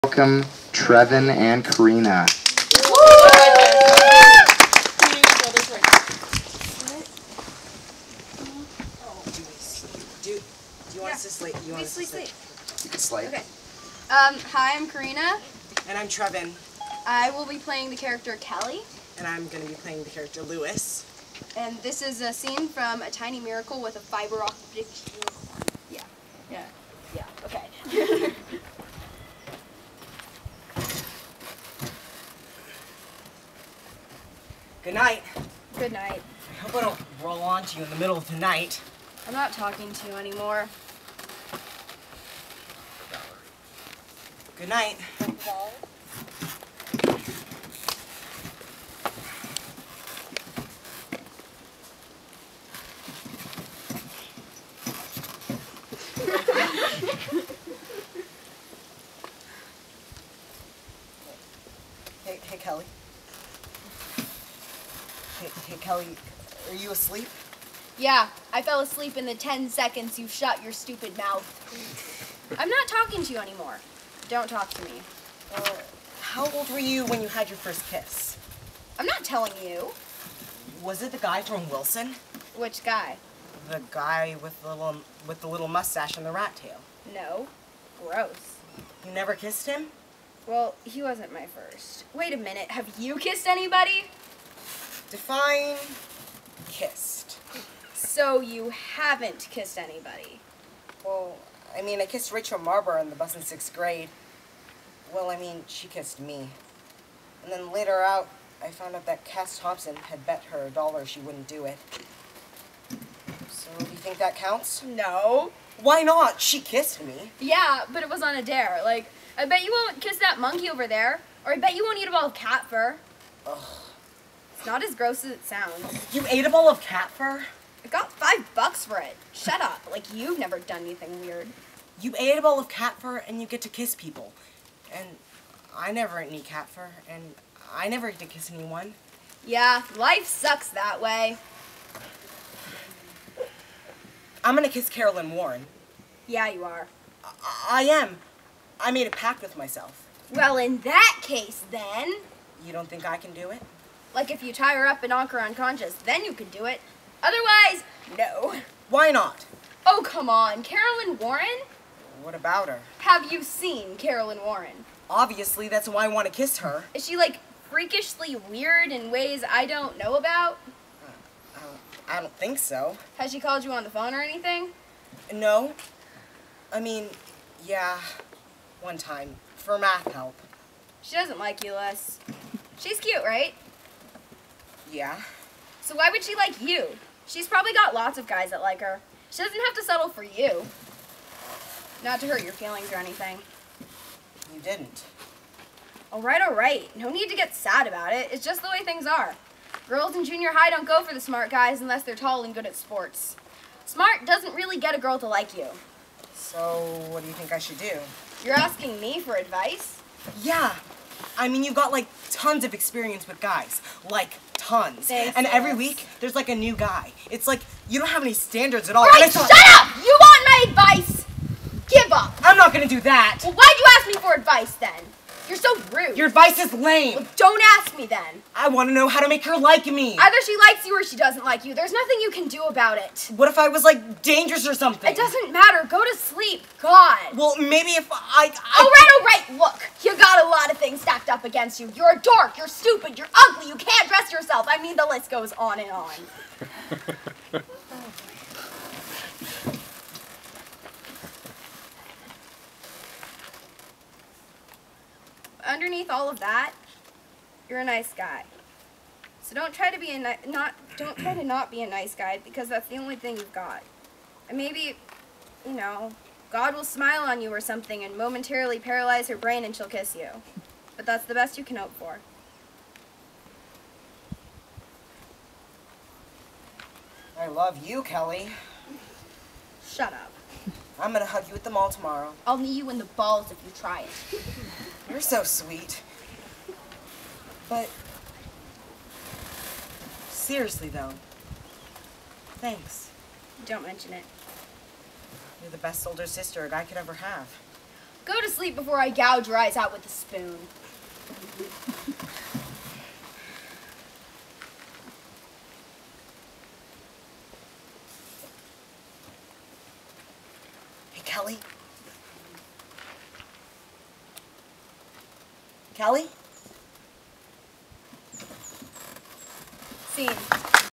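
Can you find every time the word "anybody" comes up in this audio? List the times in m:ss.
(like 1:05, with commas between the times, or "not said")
1:33, 1:39.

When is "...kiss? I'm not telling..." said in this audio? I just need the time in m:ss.
1:17.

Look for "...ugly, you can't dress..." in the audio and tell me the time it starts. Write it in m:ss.
4:03.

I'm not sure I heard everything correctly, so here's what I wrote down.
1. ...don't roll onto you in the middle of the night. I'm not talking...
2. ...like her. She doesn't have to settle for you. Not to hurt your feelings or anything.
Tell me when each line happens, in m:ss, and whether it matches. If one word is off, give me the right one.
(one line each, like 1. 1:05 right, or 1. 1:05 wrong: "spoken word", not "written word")
1. 0:36 right
2. 3:08 right.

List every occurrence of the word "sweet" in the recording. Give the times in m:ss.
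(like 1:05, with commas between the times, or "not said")
4:45.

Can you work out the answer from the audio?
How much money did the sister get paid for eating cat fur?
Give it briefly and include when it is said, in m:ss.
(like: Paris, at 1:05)
5 bucks, at 2:08.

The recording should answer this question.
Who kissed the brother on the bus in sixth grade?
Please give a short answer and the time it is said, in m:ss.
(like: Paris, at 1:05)
Rachel Marber, at 1:42.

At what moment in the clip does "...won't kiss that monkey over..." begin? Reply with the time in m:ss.
1:59.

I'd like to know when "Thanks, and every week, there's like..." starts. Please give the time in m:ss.
3:35.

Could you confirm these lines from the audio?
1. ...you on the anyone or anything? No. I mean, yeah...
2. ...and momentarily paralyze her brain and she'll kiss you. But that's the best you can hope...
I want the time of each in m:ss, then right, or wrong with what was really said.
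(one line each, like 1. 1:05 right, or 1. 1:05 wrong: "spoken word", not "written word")
1. 2:53 wrong: "phone", not "anyone"
2. 4:28 right.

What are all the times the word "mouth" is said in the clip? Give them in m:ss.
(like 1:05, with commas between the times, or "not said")
1:11.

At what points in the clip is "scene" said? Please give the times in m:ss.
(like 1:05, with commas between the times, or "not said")
0:22, 5:20.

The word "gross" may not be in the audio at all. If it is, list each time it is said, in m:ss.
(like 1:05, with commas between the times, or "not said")
1:28, 2:04.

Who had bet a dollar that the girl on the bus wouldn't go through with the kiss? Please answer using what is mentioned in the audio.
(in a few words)
Cass Thompson.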